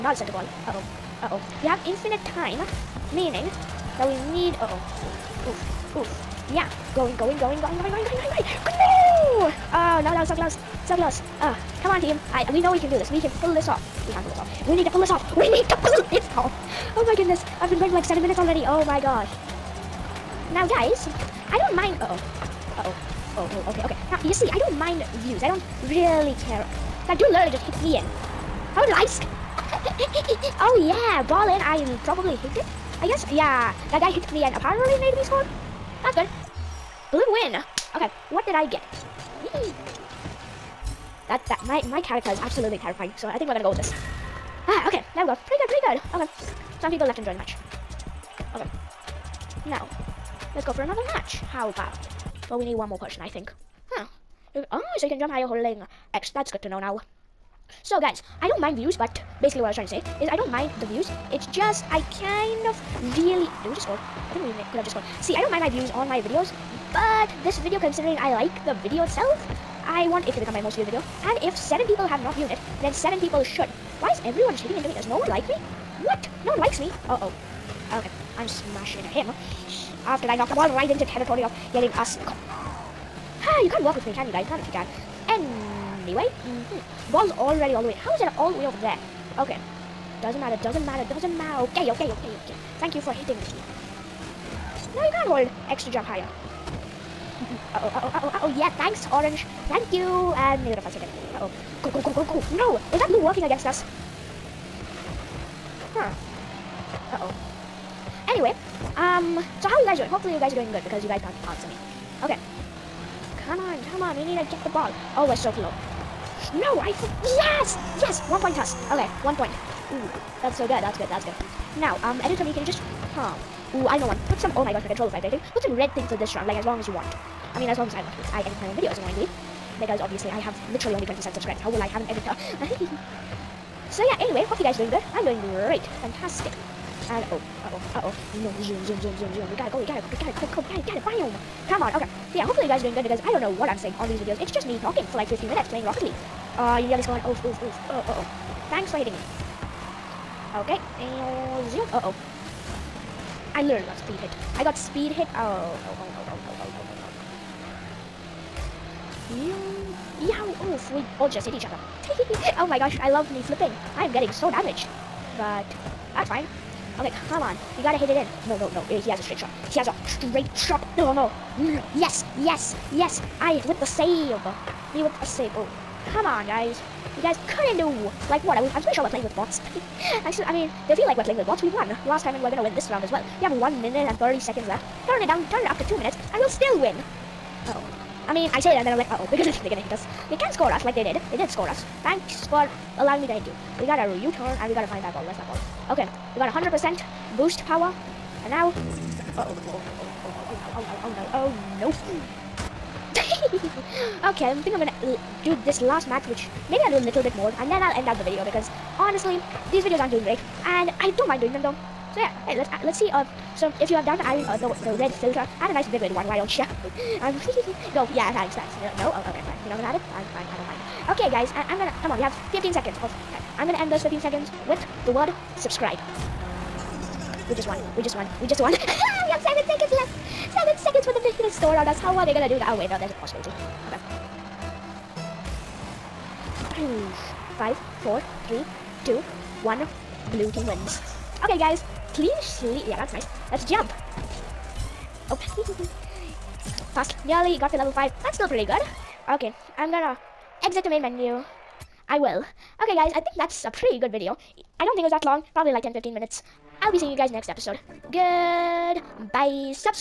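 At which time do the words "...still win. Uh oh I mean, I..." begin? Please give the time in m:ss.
3:06.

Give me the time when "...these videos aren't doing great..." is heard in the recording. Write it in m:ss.
3:29.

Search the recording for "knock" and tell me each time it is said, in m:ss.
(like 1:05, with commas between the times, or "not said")
1:20.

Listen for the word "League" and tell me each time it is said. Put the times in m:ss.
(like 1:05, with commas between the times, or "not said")
2:26.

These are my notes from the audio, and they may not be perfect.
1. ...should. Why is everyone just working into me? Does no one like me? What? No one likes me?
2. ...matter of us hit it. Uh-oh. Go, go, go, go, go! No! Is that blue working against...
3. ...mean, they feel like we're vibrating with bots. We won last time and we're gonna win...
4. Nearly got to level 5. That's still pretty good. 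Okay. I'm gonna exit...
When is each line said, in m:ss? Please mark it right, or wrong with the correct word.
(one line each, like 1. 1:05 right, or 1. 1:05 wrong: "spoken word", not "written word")
1. 1:13 wrong: "hitting", not "working"
2. 1:40 wrong: "neither", not "matter"
3. 3:00 wrong: "playing", not "vibrating"
4. 4:07 right.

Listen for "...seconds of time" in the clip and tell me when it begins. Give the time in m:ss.
3:42.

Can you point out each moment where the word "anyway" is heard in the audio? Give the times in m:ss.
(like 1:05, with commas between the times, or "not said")
1:26, 1:48, 2:14.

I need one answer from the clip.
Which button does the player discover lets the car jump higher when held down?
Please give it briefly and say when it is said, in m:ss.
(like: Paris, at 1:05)
X, at 0:55.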